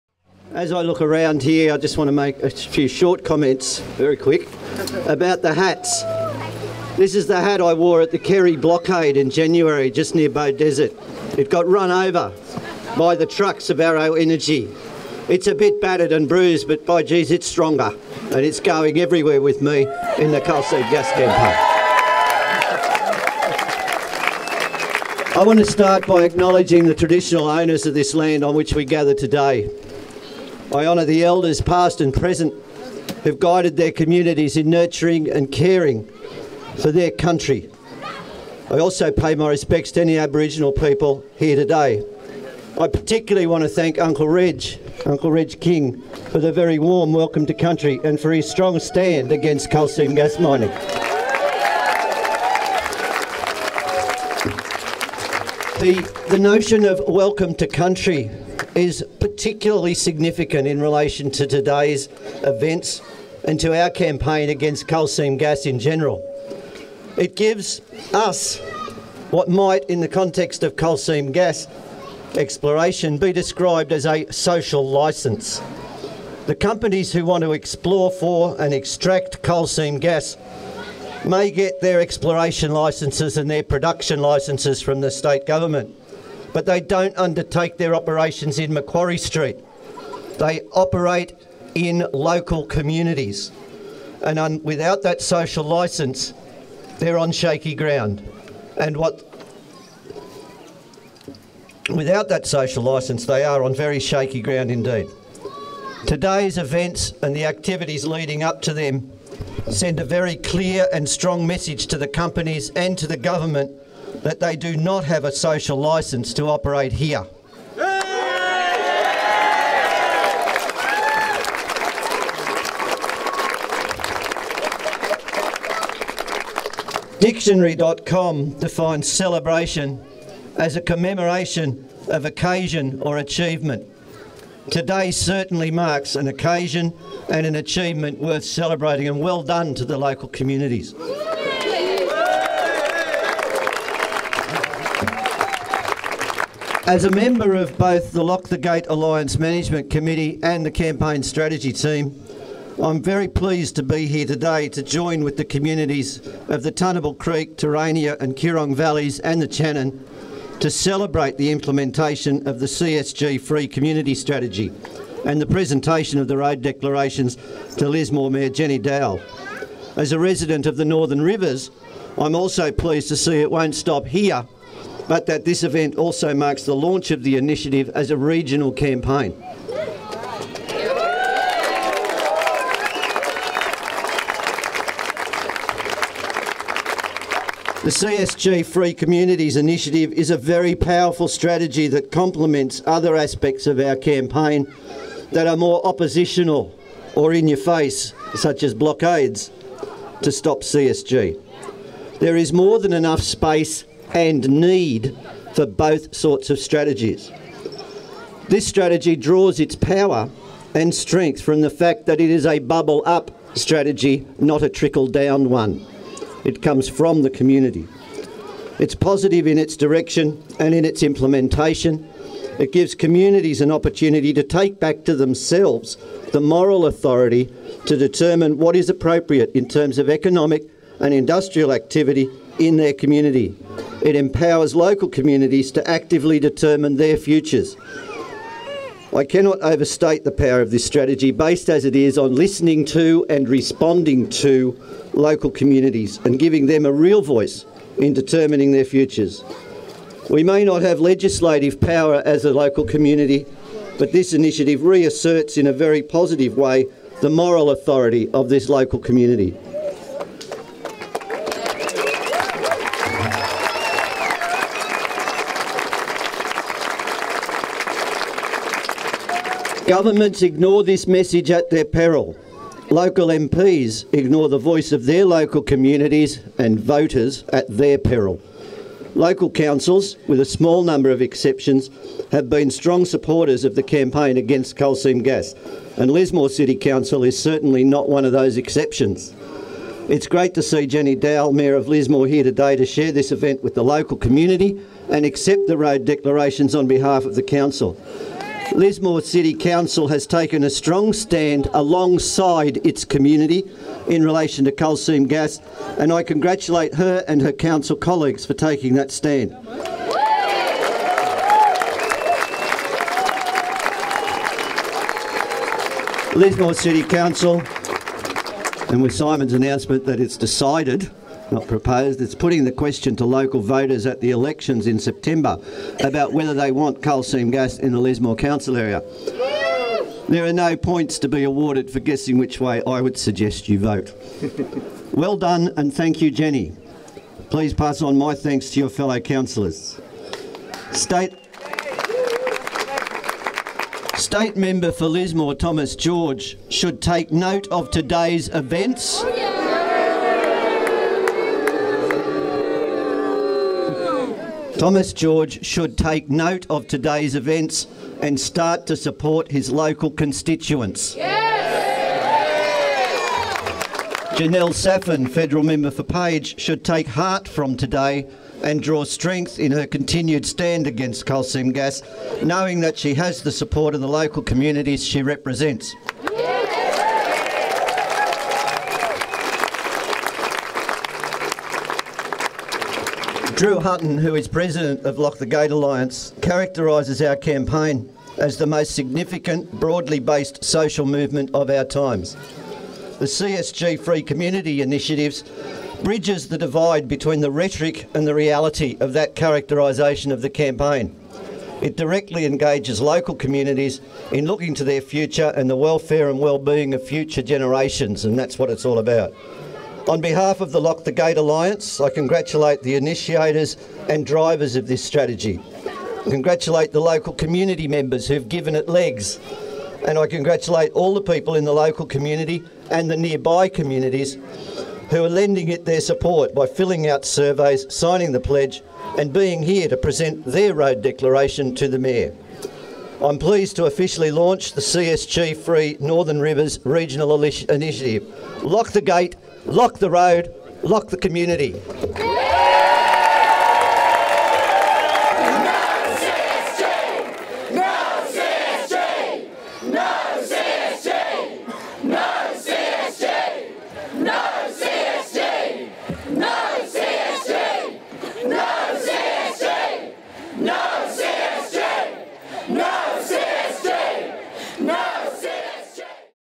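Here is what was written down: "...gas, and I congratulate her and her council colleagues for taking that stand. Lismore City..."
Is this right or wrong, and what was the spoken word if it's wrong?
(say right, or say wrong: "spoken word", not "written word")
right.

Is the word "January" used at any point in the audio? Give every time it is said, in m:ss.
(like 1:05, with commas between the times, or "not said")
0:09.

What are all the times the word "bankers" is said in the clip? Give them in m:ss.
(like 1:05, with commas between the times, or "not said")
not said.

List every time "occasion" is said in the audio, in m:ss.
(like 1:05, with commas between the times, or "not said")
2:12, 2:16.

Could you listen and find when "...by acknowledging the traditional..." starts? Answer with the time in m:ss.
0:26.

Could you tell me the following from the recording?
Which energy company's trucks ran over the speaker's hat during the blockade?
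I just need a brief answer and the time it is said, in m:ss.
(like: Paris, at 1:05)
Arrow Energy, at 0:13.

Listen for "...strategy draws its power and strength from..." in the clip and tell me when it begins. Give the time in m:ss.
3:28.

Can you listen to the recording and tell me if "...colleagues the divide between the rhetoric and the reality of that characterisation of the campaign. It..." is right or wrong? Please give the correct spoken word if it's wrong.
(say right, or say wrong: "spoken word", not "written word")
wrong: "bridges", not "colleagues".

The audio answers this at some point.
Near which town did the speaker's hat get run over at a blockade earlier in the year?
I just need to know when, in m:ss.
0:10.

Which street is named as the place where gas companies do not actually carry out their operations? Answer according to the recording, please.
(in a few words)
Macquarie Street.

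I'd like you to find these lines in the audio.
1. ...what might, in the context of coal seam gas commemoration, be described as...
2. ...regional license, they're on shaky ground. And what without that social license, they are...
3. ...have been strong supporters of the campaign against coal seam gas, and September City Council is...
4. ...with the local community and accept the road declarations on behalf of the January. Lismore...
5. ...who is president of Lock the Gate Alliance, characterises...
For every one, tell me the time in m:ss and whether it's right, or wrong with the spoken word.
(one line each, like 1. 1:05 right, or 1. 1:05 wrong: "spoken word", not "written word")
1. 1:09 wrong: "exploration", not "commemoration"
2. 1:35 wrong: "social", not "regional"
3. 4:42 wrong: "Lismore", not "September"
4. 4:53 wrong: "Council", not "January"
5. 6:24 right.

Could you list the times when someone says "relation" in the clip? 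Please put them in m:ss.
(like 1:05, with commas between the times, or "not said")
1:00, 5:04.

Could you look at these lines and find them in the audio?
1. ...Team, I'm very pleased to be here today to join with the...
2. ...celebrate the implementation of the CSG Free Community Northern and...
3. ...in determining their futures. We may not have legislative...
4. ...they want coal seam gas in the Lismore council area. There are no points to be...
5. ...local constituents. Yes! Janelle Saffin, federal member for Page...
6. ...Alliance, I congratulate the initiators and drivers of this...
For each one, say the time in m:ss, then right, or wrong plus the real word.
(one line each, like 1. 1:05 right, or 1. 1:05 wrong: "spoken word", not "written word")
1. 2:31 right
2. 2:40 wrong: "Strategy", not "Northern"
3. 4:07 right
4. 5:26 right
5. 5:59 right
6. 6:51 right.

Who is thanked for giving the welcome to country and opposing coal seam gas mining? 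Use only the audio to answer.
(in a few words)
Uncle Reg King.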